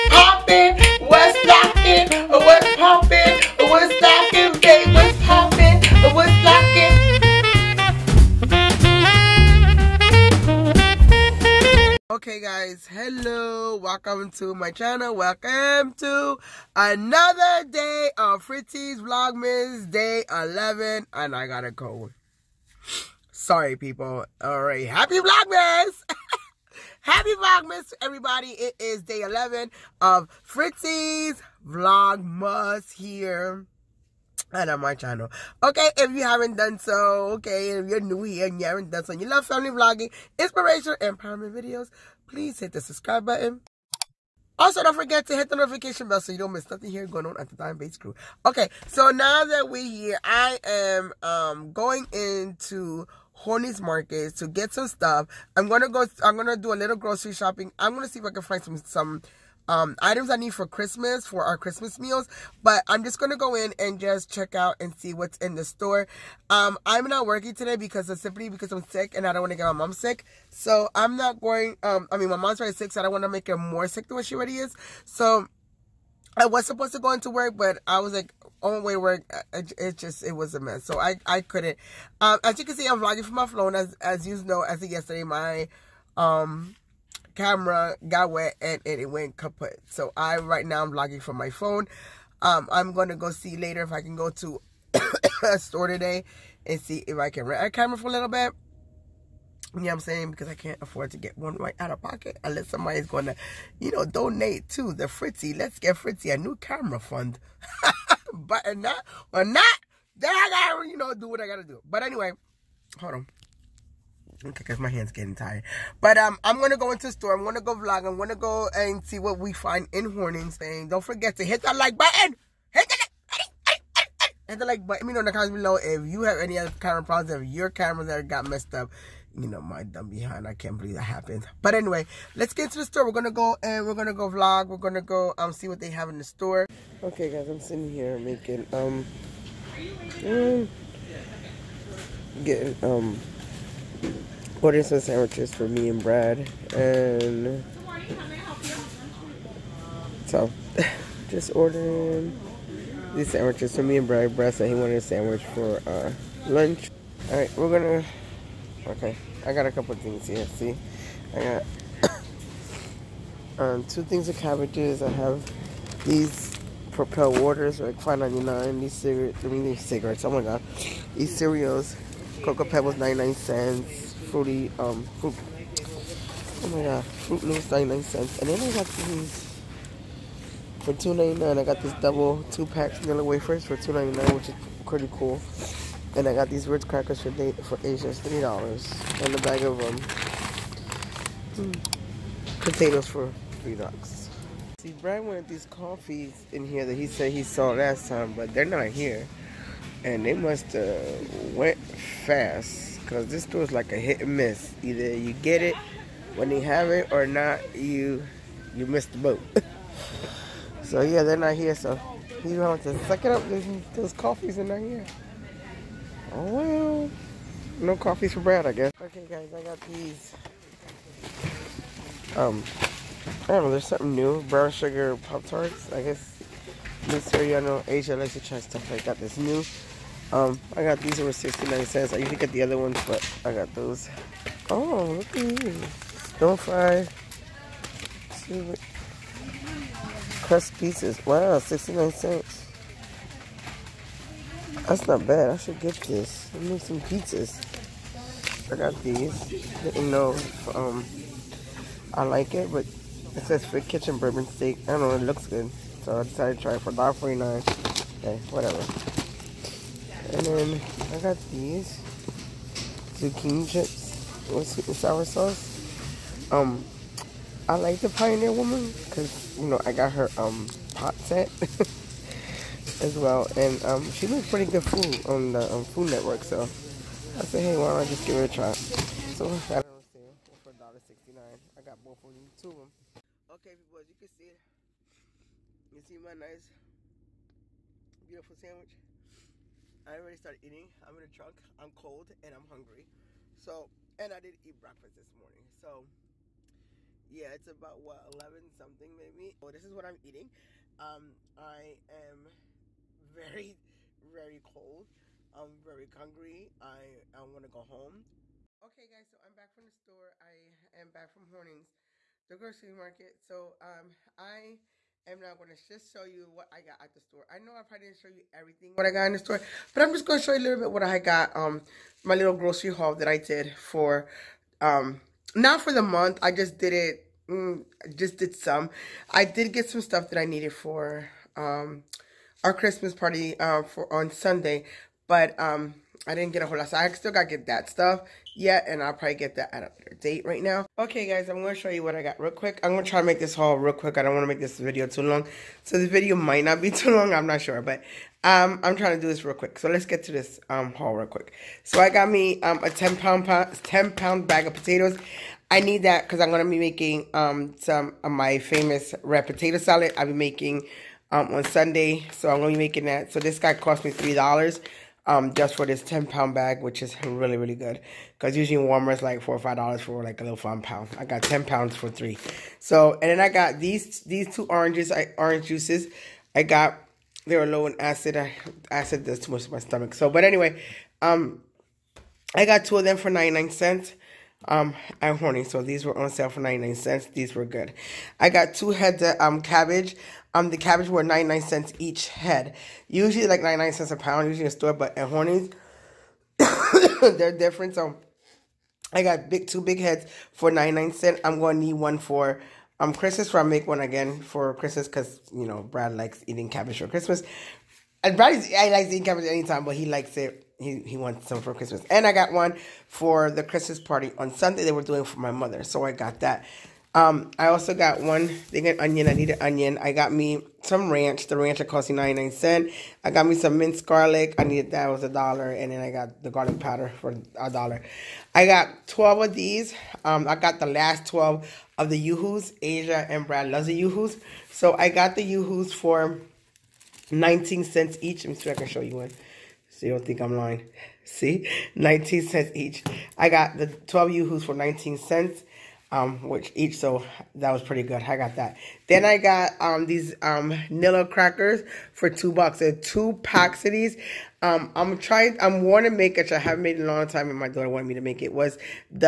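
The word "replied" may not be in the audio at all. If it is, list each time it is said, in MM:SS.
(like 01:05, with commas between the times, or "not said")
not said.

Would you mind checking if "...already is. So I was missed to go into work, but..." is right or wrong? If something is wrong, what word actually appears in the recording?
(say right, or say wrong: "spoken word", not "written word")
wrong: "supposed", not "missed".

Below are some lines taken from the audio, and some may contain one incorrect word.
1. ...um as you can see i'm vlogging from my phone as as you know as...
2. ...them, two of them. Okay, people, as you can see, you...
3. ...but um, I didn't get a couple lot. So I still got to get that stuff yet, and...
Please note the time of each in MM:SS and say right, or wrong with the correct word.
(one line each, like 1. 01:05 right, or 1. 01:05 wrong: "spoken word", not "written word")
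1. 01:22 right
2. 04:42 right
3. 05:35 wrong: "whole", not "couple".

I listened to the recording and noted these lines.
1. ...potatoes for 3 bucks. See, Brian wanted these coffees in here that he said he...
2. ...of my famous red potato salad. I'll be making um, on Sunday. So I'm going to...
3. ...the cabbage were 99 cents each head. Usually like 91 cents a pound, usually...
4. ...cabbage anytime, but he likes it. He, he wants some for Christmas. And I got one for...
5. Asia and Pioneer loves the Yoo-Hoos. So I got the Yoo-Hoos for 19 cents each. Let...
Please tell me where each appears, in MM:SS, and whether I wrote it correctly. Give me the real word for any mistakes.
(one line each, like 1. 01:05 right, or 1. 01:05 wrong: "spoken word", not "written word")
1. 03:12 right
2. 05:58 right
3. 06:30 wrong: "99", not "91"
4. 06:49 right
5. 07:12 wrong: "Brad", not "Pioneer".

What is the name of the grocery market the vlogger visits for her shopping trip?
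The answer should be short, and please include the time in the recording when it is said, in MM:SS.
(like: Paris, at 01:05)
Hornings Market, at 00:53.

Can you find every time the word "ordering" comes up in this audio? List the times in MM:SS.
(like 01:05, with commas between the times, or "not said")
02:24, 02:31.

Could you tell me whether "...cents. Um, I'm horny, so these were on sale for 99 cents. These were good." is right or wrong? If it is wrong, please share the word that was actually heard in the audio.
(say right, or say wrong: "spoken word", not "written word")
right.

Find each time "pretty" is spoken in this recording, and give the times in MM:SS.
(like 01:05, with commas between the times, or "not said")
03:04, 04:34, 07:27.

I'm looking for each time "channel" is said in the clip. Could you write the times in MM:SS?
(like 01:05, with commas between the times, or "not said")
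00:14, 00:34.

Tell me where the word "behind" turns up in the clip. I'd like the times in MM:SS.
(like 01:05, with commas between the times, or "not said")
02:10.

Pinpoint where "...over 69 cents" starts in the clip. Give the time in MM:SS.
03:51.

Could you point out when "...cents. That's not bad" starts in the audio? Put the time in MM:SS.
04:02.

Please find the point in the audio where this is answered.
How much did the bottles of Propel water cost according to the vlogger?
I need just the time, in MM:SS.
02:47.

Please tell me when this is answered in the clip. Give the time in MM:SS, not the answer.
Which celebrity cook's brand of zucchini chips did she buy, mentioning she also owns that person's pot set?
04:28.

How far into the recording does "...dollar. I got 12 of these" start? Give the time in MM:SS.
07:07.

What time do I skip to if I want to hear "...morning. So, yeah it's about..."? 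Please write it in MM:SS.
04:55.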